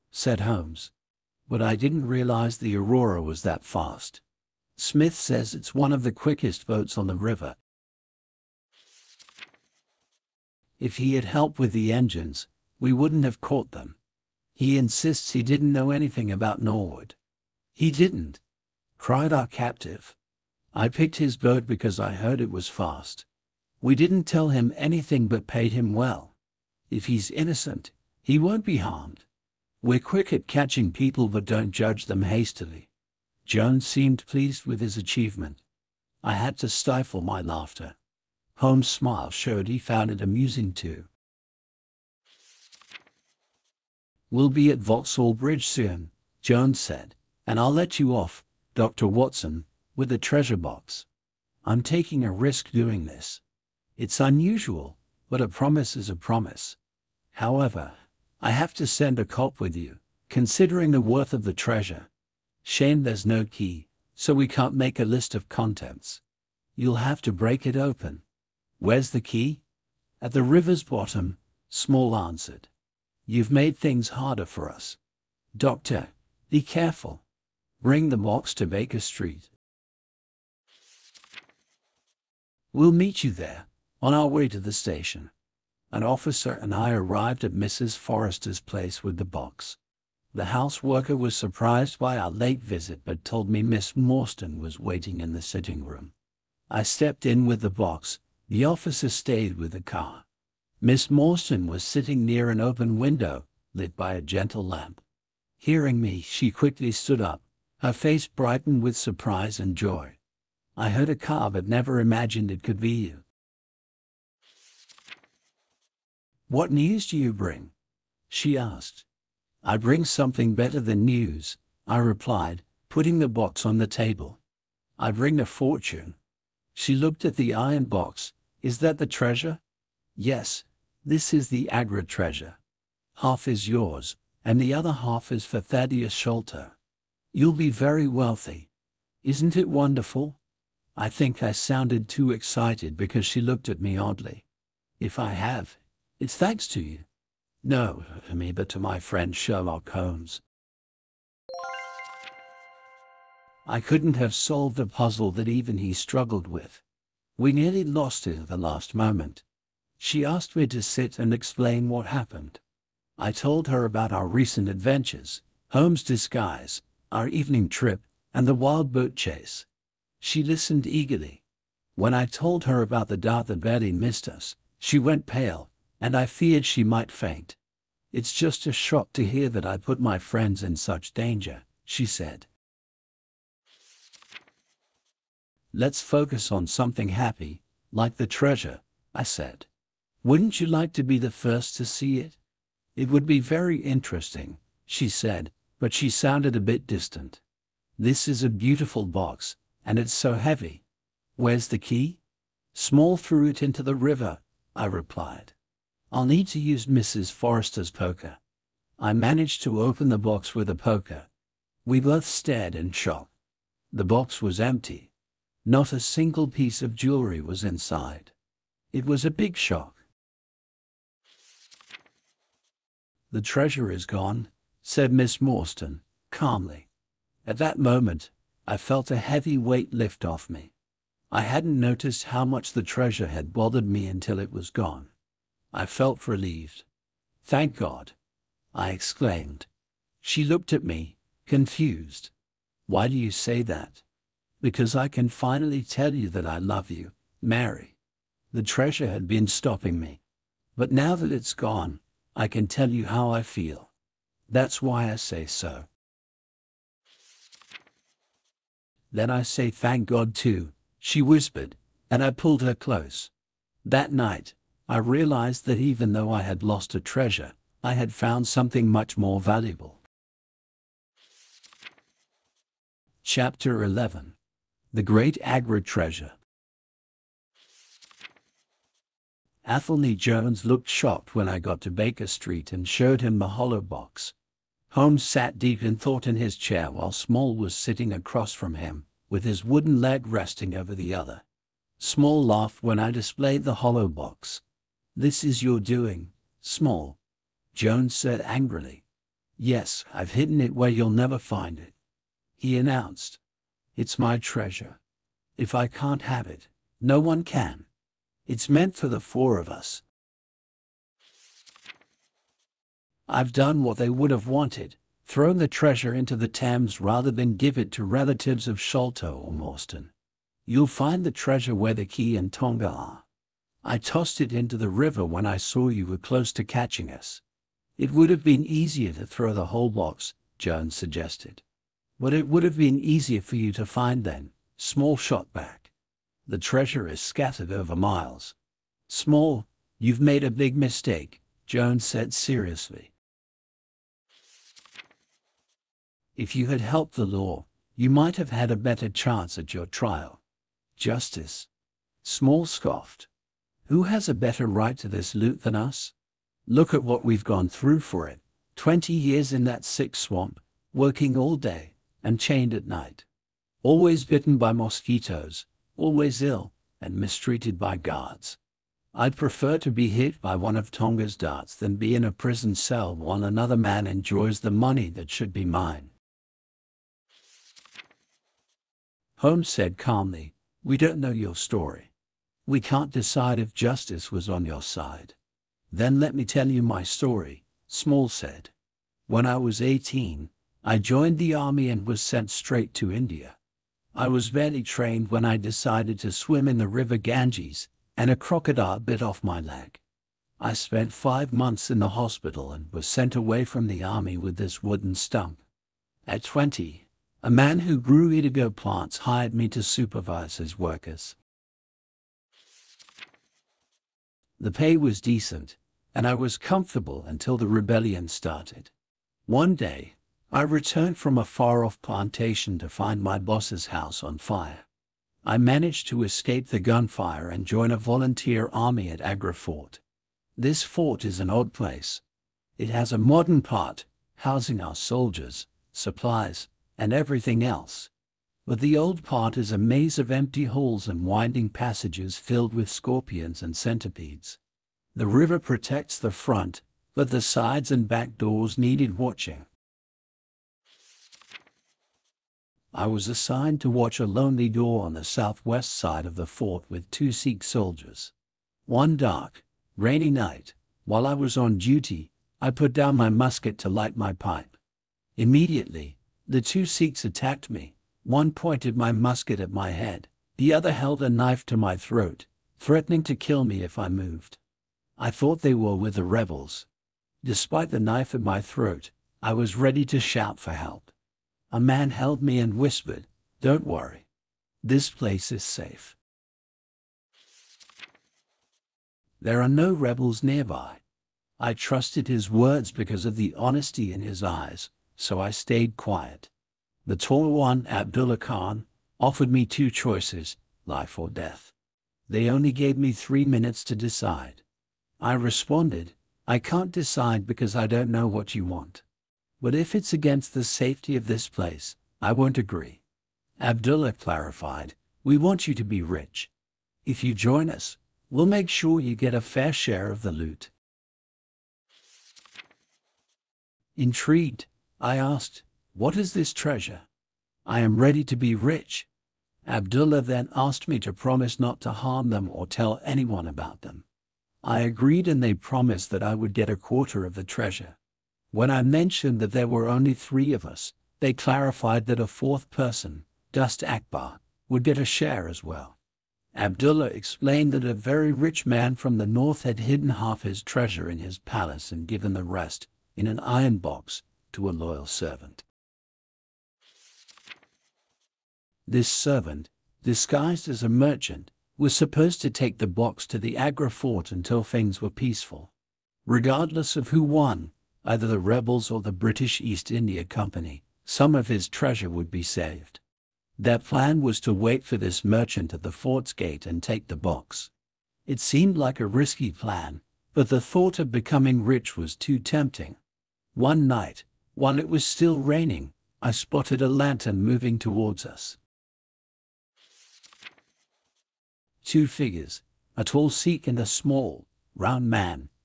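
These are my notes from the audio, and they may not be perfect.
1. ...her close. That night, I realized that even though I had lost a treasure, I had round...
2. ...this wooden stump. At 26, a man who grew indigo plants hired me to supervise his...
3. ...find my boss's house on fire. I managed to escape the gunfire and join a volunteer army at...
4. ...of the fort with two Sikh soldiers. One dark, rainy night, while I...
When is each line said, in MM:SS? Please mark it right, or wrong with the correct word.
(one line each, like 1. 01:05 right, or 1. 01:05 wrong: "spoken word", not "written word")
1. 04:22 wrong: "found", not "round"
2. 06:44 wrong: "20", not "26"
3. 07:02 right
4. 07:36 right.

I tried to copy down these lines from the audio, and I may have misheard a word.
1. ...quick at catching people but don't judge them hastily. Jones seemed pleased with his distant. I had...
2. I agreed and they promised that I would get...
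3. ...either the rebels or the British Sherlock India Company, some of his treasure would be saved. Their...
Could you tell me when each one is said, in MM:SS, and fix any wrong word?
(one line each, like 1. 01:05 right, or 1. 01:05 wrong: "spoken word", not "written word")
1. 00:29 wrong: "achievement", not "distant"
2. 08:54 right
3. 09:28 wrong: "East", not "Sherlock".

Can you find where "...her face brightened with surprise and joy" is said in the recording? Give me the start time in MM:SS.
01:47.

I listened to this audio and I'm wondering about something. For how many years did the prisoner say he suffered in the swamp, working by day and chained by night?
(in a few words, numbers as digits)
20.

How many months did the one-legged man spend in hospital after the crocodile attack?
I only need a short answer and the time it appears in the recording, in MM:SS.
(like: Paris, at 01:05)
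5, at 06:41.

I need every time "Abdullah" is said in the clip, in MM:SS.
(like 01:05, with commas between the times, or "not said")
08:17, 08:33, 08:49, 09:06.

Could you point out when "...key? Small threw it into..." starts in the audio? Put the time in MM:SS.
03:21.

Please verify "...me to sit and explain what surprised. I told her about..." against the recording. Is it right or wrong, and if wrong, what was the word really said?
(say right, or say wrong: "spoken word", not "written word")
wrong: "happened", not "surprised".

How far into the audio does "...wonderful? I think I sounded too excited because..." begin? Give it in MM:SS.
02:19.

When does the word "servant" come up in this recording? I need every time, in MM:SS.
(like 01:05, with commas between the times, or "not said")
09:15, 09:19.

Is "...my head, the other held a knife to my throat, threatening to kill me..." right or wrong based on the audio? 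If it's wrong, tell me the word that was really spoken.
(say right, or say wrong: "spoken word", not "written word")
right.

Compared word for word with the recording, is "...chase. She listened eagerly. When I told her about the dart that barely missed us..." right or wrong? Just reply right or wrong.
right.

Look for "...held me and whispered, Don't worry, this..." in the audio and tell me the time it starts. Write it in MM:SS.
08:02.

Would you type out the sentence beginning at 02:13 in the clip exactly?
Half is yours, and the other half is for Thaddeus Sholto.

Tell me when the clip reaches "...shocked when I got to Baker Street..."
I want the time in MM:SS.
04:40.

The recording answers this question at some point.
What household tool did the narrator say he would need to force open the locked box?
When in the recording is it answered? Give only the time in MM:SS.
03:26.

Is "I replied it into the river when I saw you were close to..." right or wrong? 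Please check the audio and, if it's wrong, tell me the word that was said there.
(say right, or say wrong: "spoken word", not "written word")
wrong: "tossed", not "replied".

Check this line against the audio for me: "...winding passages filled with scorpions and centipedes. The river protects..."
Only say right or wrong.
right.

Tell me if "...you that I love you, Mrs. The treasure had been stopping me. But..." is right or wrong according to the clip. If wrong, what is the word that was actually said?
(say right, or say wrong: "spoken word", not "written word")
wrong: "Mary", not "Mrs".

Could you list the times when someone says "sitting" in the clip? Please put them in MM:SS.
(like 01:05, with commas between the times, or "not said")
01:35, 01:41, 04:47.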